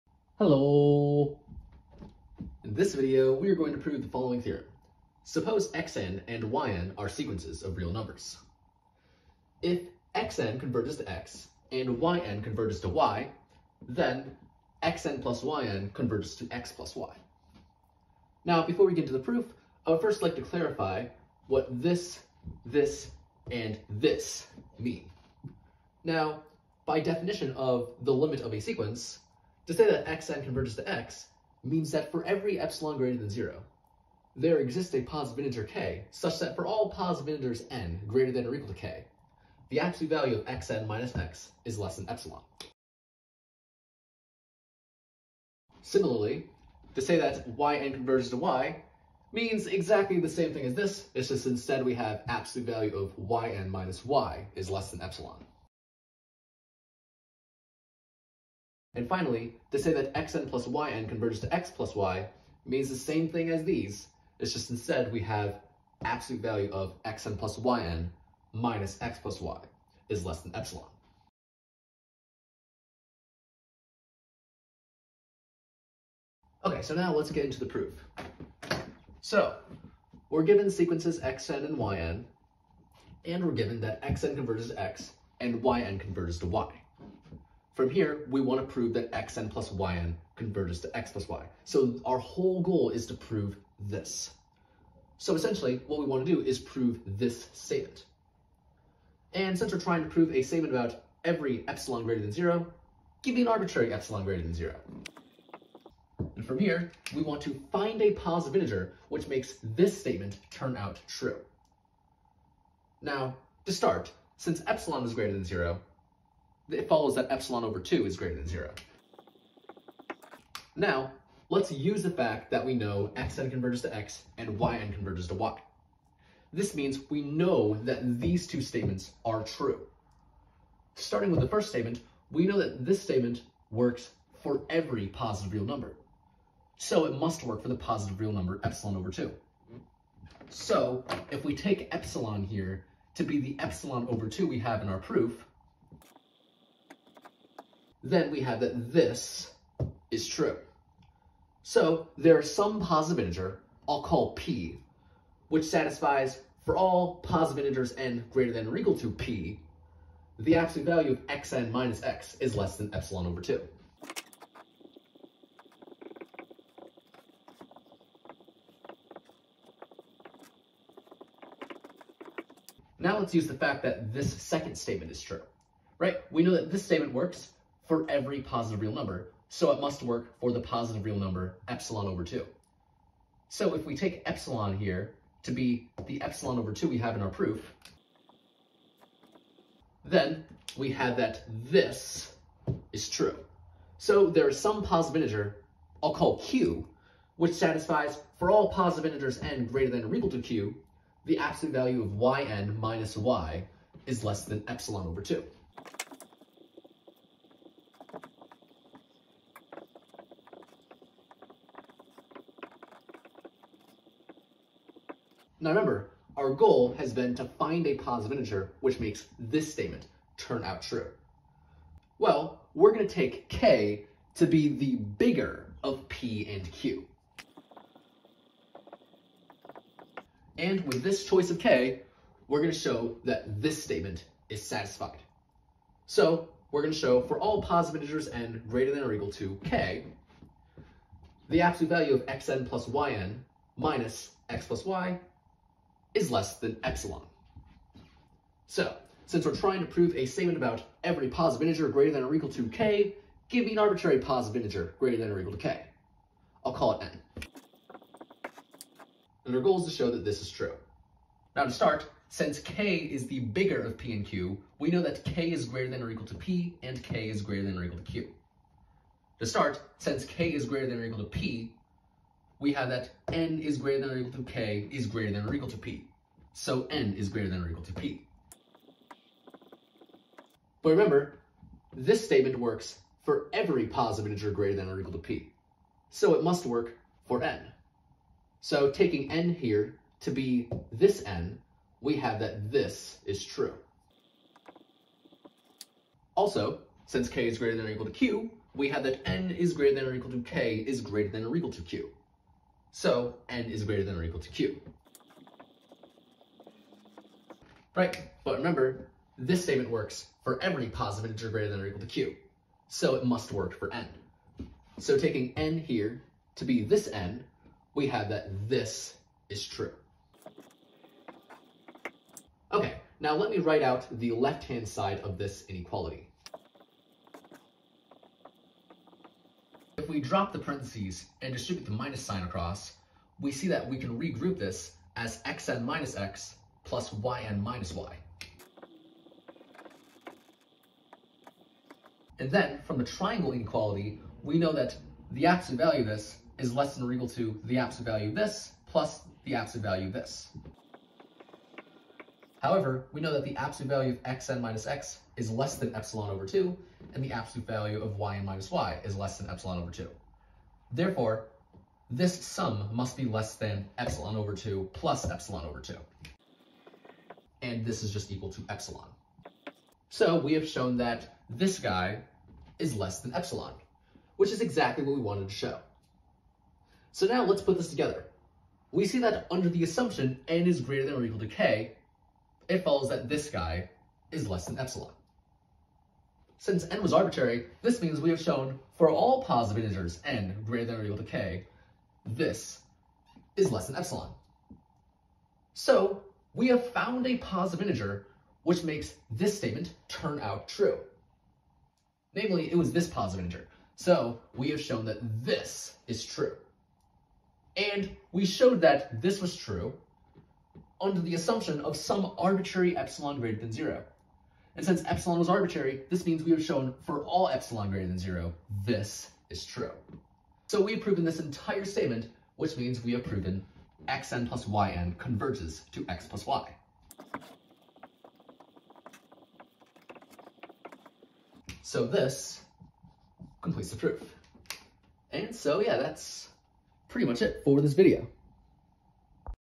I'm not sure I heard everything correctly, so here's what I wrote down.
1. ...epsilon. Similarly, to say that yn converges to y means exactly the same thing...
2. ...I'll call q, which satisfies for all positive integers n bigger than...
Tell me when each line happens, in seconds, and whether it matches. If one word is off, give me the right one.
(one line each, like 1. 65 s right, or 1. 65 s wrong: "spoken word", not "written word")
1. 42 s right
2. 196 s wrong: "greater", not "bigger".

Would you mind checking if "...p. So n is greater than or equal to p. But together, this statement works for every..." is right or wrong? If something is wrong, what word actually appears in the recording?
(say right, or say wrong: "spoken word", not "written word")
wrong: "remember", not "together".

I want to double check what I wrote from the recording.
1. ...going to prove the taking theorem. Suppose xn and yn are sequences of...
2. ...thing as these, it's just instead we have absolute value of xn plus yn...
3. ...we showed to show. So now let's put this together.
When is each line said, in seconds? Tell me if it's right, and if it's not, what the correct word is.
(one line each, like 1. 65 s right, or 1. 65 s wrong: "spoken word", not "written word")
1. 3 s wrong: "following", not "taking"
2. 63 s right
3. 375 s wrong: "wanted", not "showed".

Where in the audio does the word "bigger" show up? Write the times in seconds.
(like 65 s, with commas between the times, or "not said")
224 s, 263 s.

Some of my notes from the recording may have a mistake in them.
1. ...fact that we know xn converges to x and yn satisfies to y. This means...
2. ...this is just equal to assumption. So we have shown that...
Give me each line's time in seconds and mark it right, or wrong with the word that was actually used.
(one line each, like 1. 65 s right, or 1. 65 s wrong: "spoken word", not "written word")
1. 122 s wrong: "converges", not "satisfies"
2. 367 s wrong: "epsilon", not "assumption".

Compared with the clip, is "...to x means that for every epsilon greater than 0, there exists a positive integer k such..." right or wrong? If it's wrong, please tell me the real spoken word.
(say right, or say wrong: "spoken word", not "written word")
right.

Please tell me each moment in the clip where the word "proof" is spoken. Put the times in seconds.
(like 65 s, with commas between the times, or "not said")
19 s, 77 s, 144 s, 187 s, 433 s.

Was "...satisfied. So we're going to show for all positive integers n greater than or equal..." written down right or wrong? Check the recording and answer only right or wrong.
right.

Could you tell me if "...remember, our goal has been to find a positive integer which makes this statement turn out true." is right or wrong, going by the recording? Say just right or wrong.
right.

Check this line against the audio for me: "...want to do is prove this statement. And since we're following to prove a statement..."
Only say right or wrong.
wrong.